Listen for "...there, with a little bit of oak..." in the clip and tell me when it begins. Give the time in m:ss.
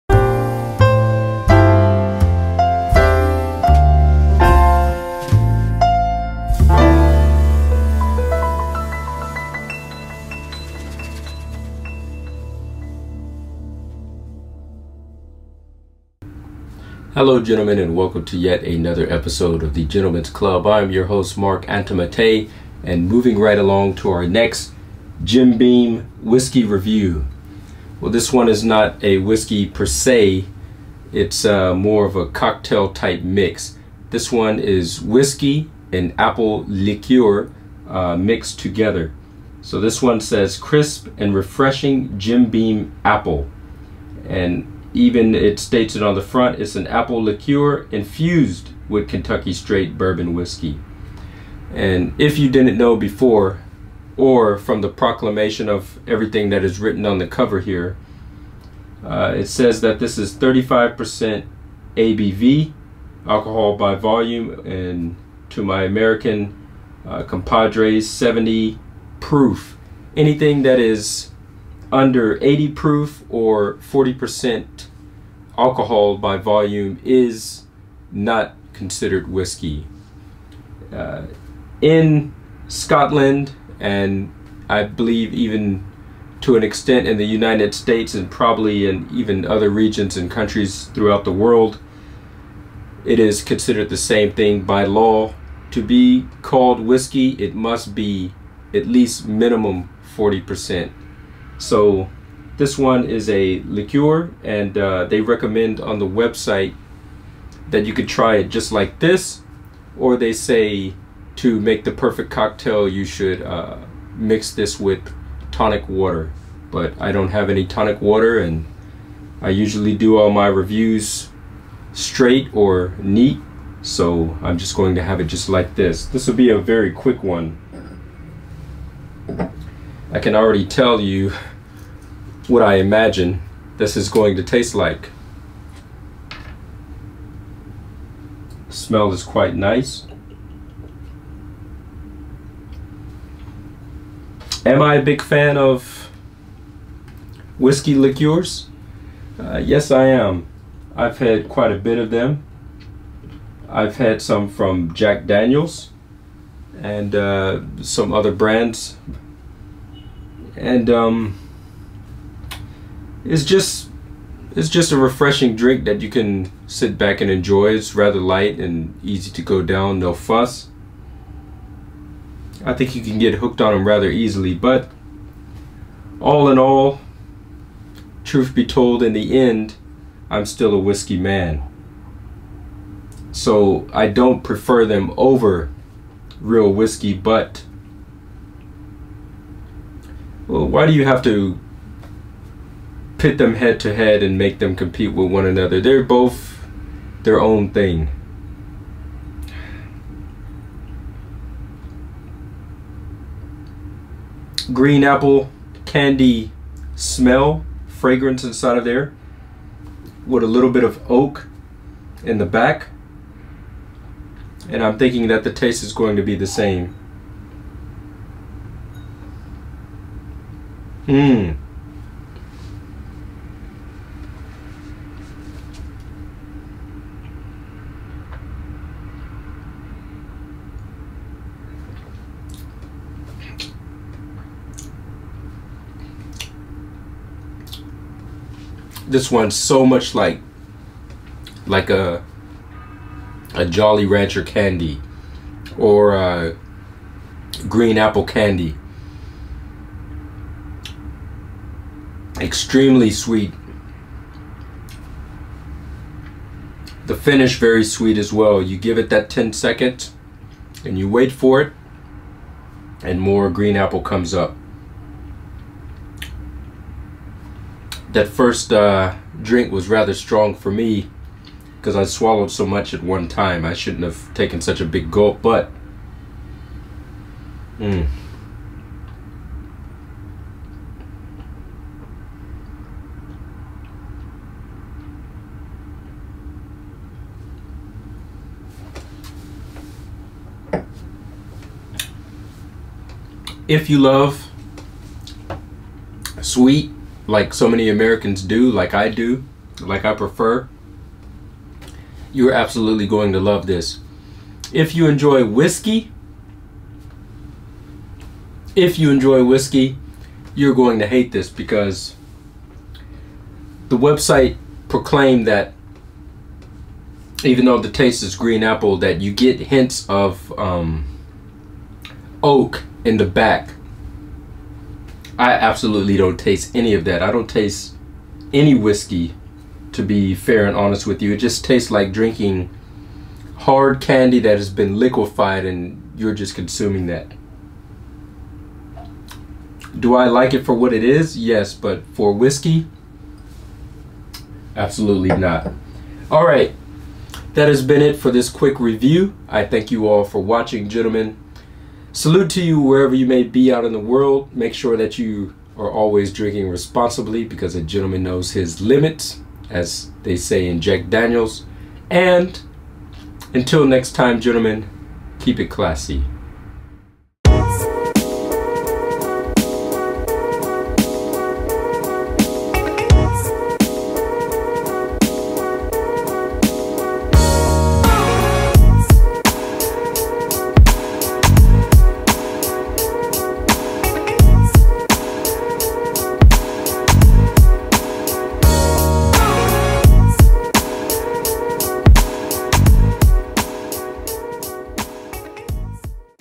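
3:28.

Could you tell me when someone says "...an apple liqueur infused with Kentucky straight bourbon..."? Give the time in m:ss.
0:46.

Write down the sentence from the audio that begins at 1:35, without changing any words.
To be called whiskey, it must be at least minimum 40%.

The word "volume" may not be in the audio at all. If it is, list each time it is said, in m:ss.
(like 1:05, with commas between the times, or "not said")
1:03, 1:16.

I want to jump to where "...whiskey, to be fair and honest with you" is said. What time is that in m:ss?
5:28.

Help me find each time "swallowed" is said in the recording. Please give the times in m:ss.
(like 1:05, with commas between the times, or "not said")
4:32.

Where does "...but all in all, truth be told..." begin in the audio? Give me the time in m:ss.
2:54.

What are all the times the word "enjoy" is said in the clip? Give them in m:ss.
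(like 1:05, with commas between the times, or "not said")
2:47, 5:05, 5:09.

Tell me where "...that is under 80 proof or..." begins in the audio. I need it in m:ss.
1:10.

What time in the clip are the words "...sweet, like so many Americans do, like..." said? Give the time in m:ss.
4:56.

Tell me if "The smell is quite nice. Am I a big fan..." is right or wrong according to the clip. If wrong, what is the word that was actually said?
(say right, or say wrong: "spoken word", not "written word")
right.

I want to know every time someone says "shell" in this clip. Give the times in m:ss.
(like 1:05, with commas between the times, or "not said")
not said.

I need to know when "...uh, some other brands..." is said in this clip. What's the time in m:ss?
2:37.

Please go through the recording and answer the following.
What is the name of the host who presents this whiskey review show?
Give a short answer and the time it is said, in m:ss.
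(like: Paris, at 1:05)
Marc Antomattei, at 0:21.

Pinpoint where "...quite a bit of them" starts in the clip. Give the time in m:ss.
2:31.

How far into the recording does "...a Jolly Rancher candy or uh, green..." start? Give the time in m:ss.
4:03.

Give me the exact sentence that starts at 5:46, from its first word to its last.
All right, that has been it for this quick review.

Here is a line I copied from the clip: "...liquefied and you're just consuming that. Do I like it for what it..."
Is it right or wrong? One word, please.
right.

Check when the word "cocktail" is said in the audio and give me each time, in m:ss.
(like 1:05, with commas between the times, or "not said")
0:32, 1:52.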